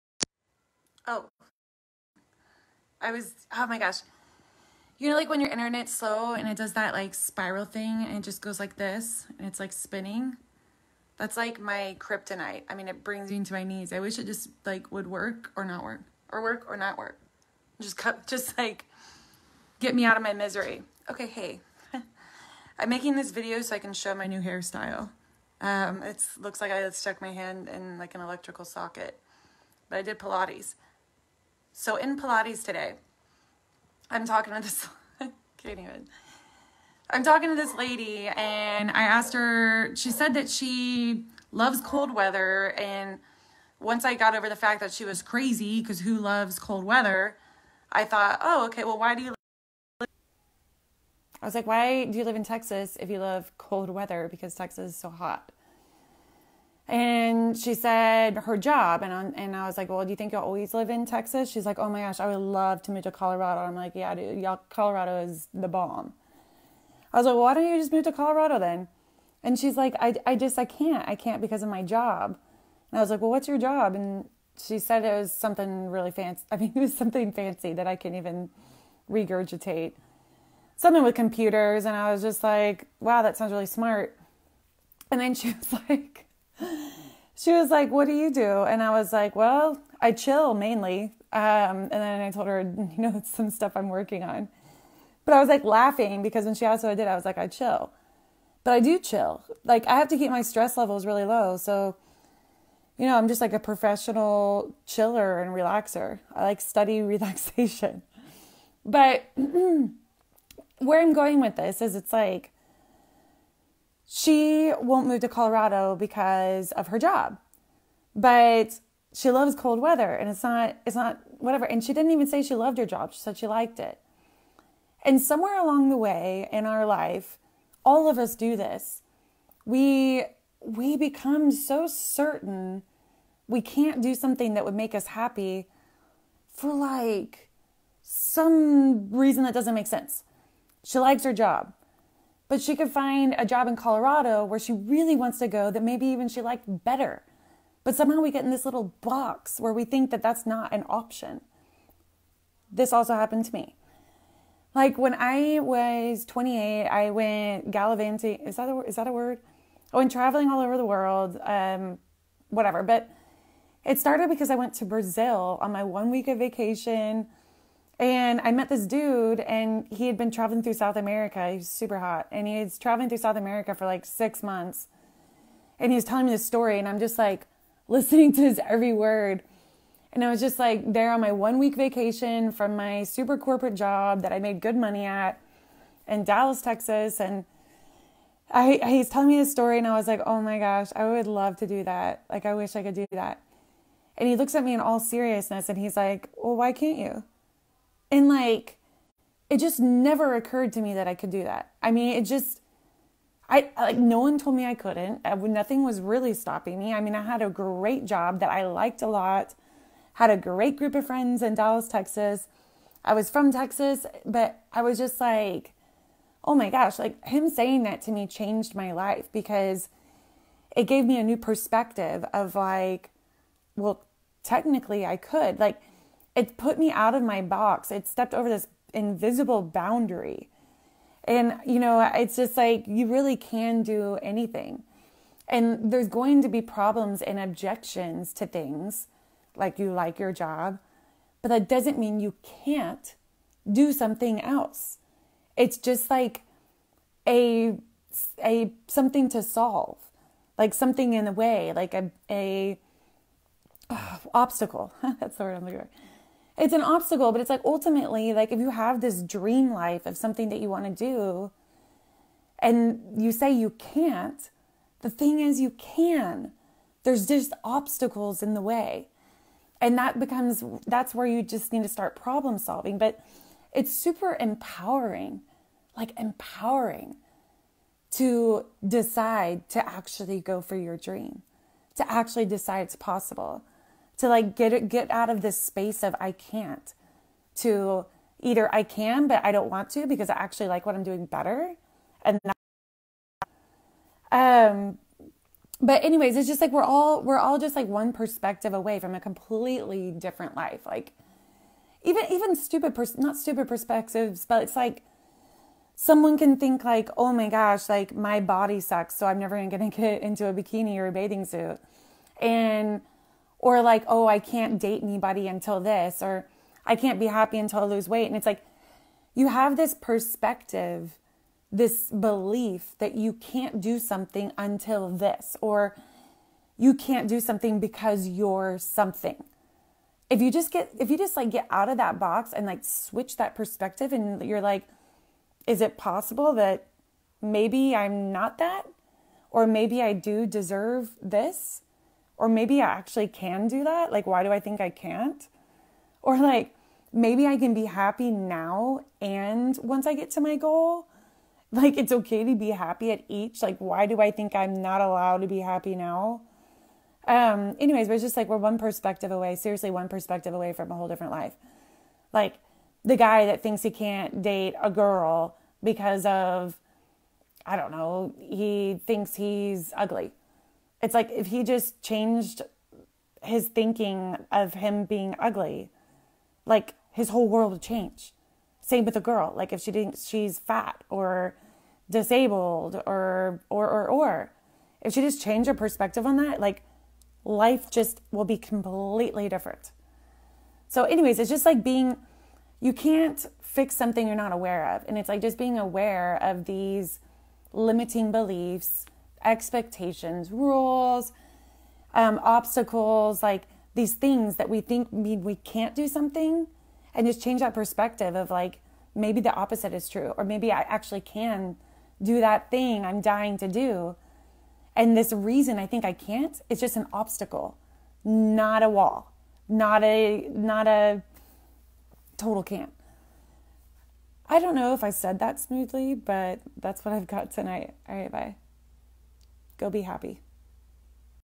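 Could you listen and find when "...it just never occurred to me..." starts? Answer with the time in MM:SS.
03:19.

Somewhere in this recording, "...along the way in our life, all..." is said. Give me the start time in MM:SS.
02:05.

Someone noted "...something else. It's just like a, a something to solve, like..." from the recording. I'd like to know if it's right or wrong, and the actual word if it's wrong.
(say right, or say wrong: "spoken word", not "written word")
right.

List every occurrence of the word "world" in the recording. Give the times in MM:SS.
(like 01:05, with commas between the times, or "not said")
02:40, 06:17.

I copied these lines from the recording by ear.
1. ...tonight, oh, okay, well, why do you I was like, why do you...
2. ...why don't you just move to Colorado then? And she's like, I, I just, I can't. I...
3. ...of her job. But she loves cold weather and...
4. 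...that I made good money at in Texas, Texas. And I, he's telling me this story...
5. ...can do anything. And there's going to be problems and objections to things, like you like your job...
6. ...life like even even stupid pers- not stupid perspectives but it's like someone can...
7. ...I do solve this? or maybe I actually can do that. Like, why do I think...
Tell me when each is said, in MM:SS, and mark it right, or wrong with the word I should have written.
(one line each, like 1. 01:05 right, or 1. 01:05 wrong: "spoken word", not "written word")
1. 00:48 wrong: "thought", not "tonight"
2. 01:07 right
3. 01:56 right
4. 03:04 wrong: "Dallas", not "Texas"
5. 03:53 right
6. 05:00 right
7. 05:40 wrong: "deserve", not "solve".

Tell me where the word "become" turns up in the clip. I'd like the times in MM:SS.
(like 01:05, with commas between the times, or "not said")
02:10, 04:30.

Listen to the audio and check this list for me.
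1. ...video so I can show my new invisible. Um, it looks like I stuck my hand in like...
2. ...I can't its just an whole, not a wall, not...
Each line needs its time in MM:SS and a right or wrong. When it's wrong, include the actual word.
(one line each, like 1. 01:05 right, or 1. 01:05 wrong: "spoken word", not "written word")
1. 00:23 wrong: "hairstyle", not "invisible"
2. 06:56 wrong: "obstacle", not "whole".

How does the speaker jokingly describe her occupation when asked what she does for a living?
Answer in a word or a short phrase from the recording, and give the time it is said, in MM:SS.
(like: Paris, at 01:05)
Professional chiller, at 01:43.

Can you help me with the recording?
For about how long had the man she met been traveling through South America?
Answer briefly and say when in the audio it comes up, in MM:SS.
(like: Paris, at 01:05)
6 months, at 02:54.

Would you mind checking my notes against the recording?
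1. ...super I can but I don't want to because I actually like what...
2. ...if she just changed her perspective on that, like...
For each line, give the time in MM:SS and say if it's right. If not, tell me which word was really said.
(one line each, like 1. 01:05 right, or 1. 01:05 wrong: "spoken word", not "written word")
1. 04:48 wrong: "either", not "super"
2. 06:25 right.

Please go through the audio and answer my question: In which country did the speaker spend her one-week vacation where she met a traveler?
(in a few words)
Brazil.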